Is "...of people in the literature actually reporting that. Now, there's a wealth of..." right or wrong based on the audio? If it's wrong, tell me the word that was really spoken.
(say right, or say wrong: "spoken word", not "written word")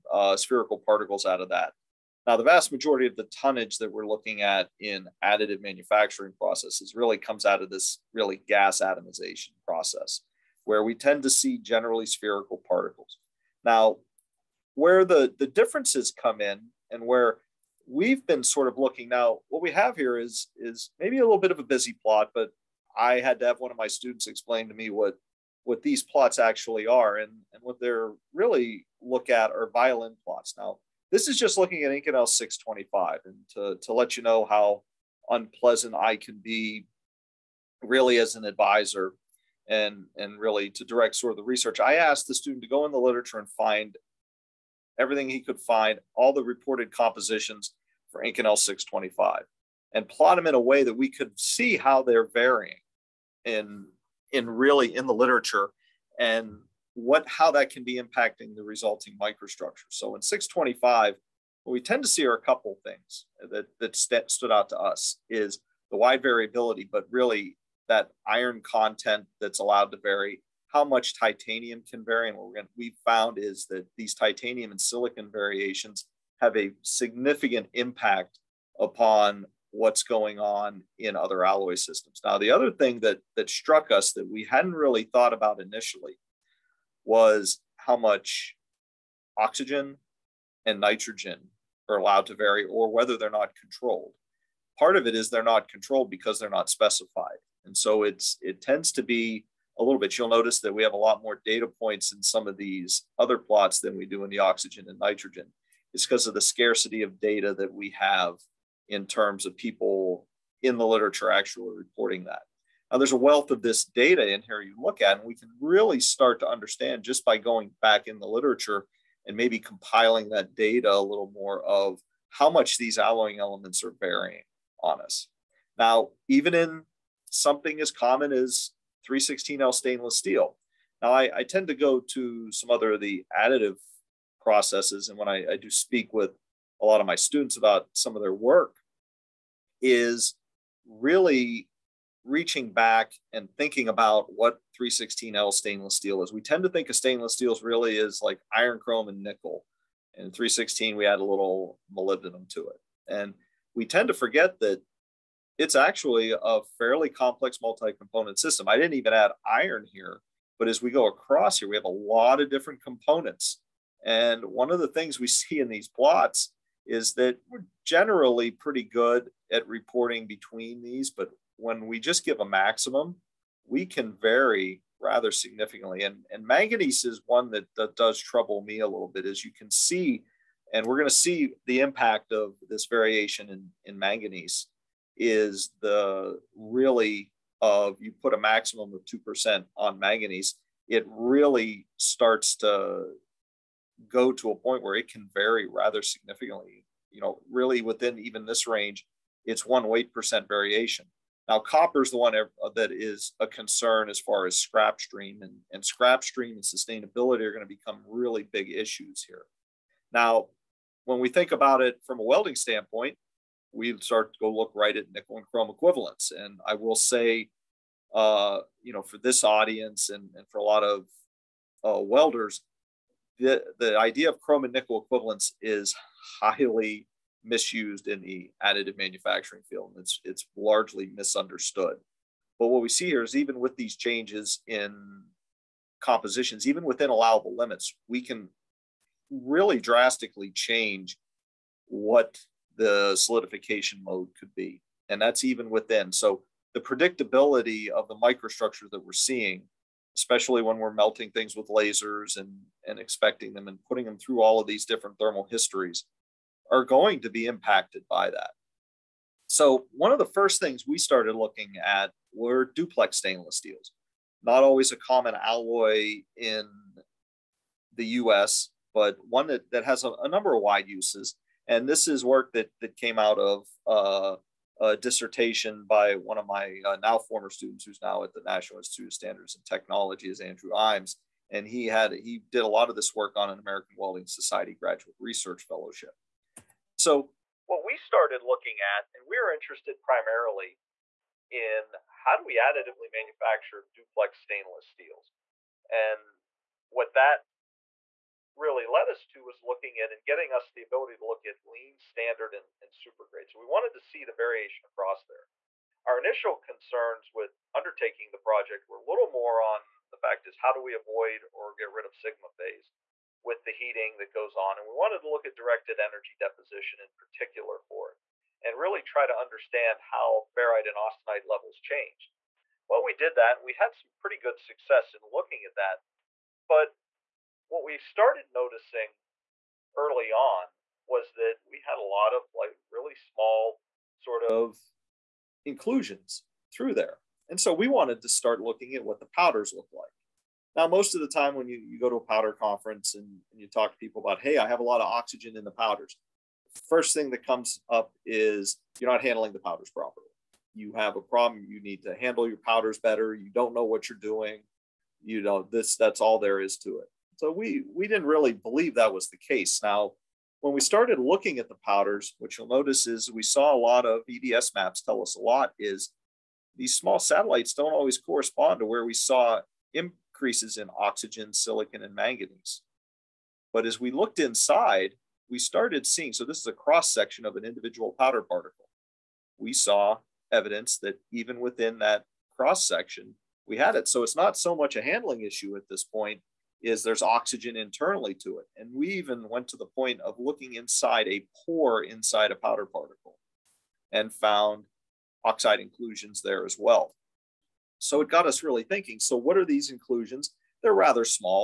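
right.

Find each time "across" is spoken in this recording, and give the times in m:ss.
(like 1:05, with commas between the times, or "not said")
2:41, 5:04.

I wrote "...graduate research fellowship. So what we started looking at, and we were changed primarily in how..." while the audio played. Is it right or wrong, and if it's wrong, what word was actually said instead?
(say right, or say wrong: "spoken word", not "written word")
wrong: "interested", not "changed".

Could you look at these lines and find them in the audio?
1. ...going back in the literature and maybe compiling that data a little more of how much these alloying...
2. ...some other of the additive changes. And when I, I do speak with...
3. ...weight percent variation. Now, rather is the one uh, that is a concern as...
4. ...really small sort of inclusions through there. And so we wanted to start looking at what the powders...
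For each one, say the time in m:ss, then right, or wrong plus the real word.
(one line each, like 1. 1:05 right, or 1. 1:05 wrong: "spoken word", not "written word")
1. 1:57 right
2. 2:12 wrong: "processes", not "changes"
3. 3:19 wrong: "copper", not "rather"
4. 5:32 right.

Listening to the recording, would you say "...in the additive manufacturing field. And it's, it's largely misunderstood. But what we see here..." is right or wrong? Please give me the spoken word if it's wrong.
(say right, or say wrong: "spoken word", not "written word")
right.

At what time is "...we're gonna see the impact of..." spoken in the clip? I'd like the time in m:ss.
3:00.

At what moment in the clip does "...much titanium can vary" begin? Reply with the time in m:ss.
1:10.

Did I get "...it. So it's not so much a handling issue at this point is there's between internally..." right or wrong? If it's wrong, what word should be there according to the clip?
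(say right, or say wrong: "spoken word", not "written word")
wrong: "oxygen", not "between".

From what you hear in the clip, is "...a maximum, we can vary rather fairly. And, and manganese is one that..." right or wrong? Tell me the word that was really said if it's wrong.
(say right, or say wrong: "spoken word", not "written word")
wrong: "significantly", not "fairly".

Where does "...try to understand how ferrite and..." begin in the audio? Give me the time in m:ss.
5:19.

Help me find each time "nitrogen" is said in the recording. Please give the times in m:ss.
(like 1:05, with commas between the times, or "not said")
1:30, 1:44.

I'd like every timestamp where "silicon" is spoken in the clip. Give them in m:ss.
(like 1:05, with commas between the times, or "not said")
1:14, 6:11.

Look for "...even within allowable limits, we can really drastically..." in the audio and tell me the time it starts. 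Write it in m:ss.
3:56.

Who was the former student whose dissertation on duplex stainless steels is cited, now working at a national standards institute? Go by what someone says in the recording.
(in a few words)
Andrew Iams.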